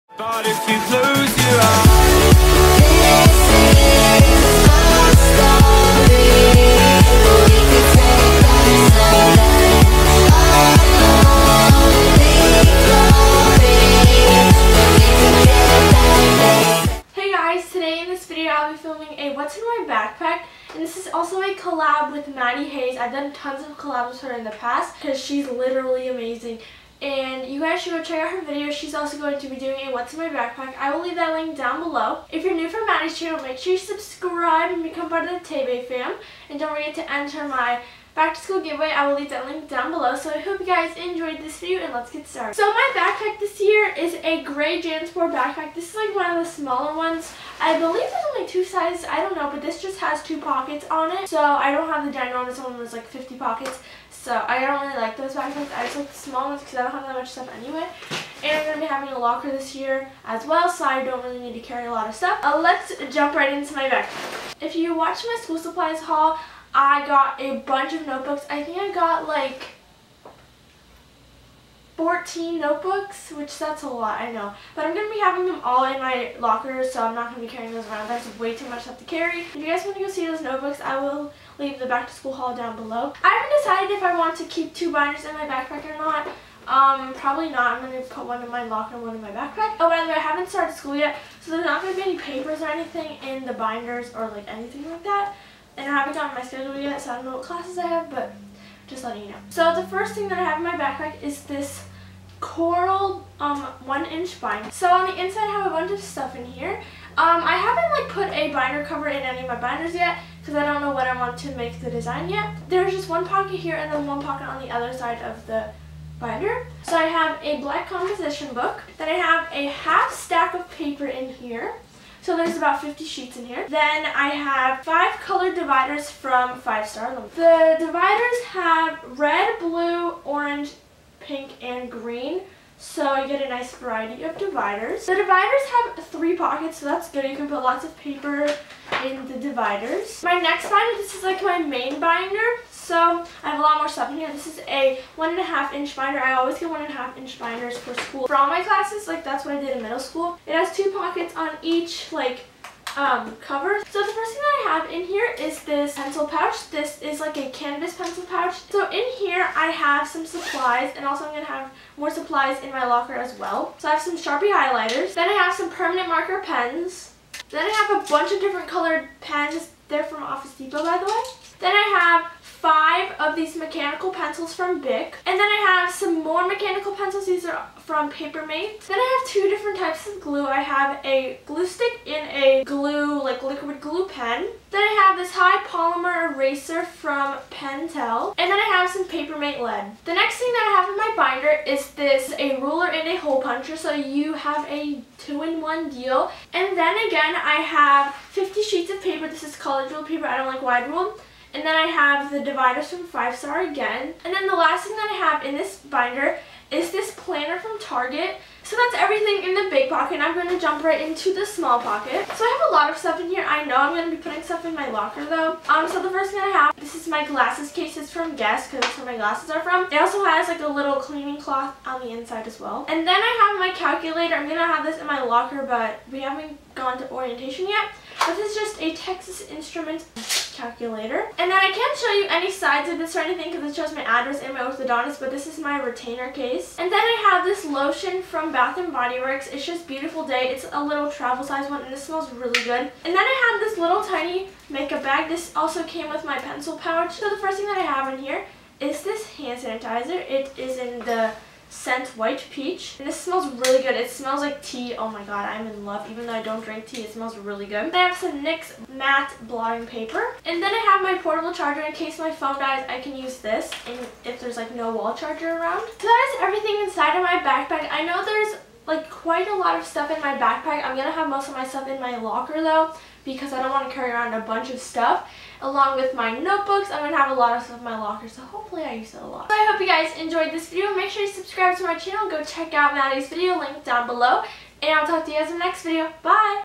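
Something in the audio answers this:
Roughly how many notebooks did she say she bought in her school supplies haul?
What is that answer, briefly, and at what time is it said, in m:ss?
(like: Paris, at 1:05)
14, at 1:12.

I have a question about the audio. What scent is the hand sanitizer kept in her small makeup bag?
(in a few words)
White peach.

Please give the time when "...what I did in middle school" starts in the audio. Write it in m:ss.
2:29.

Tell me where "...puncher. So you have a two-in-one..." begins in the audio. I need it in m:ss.
3:13.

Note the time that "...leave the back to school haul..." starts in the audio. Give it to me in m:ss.
1:21.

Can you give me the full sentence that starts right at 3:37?
It's from Guess because that's where my glasses are from.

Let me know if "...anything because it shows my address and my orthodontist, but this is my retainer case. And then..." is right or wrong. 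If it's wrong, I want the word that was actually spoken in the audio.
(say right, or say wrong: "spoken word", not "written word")
right.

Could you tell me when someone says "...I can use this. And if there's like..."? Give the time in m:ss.
4:22.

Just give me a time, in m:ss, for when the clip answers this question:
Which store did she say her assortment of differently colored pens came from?
2:50.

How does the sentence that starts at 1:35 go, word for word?
And I haven't gotten my schedule yet, so I don't know what classes I have, but just letting you know.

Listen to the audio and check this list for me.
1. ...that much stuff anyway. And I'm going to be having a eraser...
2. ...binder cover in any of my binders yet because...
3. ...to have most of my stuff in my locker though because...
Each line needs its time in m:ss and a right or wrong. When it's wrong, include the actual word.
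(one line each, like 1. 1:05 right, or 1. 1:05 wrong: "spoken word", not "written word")
1. 0:57 wrong: "locker", not "eraser"
2. 1:48 right
3. 4:31 right.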